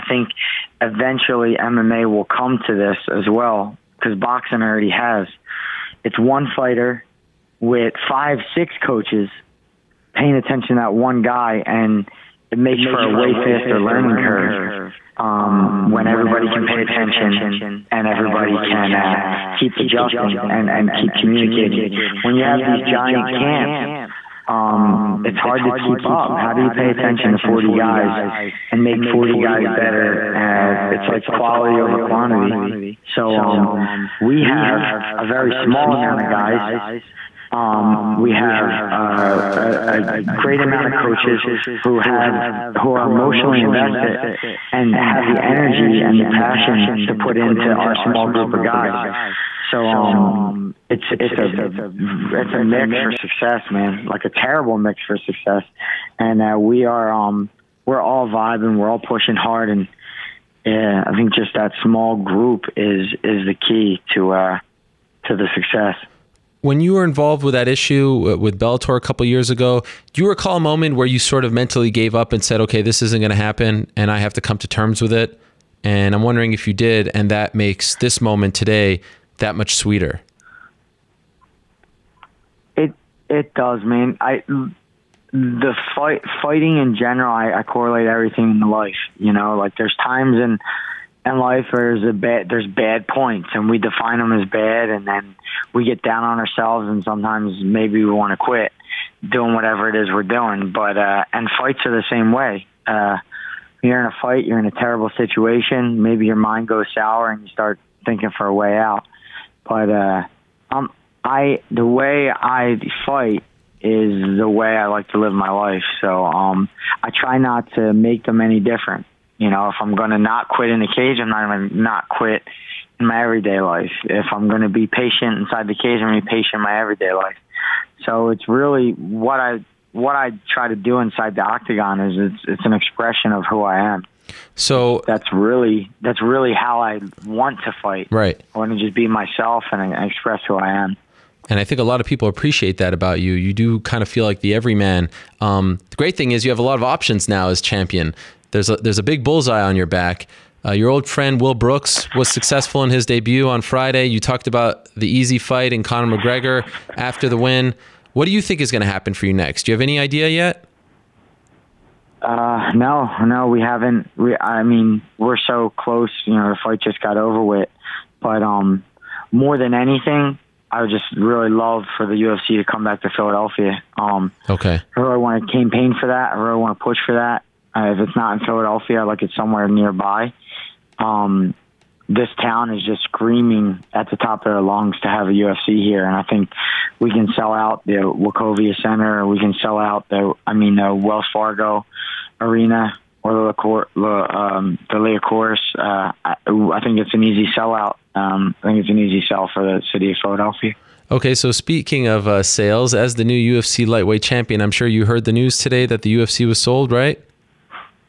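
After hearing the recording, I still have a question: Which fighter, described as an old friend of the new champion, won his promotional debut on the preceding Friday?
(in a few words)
Will Brooks.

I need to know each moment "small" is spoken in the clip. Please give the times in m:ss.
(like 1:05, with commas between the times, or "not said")
0:35, 0:47, 1:01.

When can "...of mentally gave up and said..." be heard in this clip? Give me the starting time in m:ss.
1:11.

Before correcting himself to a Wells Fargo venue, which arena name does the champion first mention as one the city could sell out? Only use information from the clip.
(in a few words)
Wachovia Center.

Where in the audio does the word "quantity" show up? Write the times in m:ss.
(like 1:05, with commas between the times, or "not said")
0:31.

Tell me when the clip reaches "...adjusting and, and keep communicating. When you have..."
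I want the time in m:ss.
0:19.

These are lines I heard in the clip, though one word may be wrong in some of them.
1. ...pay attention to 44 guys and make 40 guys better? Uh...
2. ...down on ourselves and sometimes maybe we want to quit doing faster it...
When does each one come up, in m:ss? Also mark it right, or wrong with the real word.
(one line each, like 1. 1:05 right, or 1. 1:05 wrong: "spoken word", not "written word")
1. 0:26 wrong: "40", not "44"
2. 1:36 wrong: "whatever", not "faster".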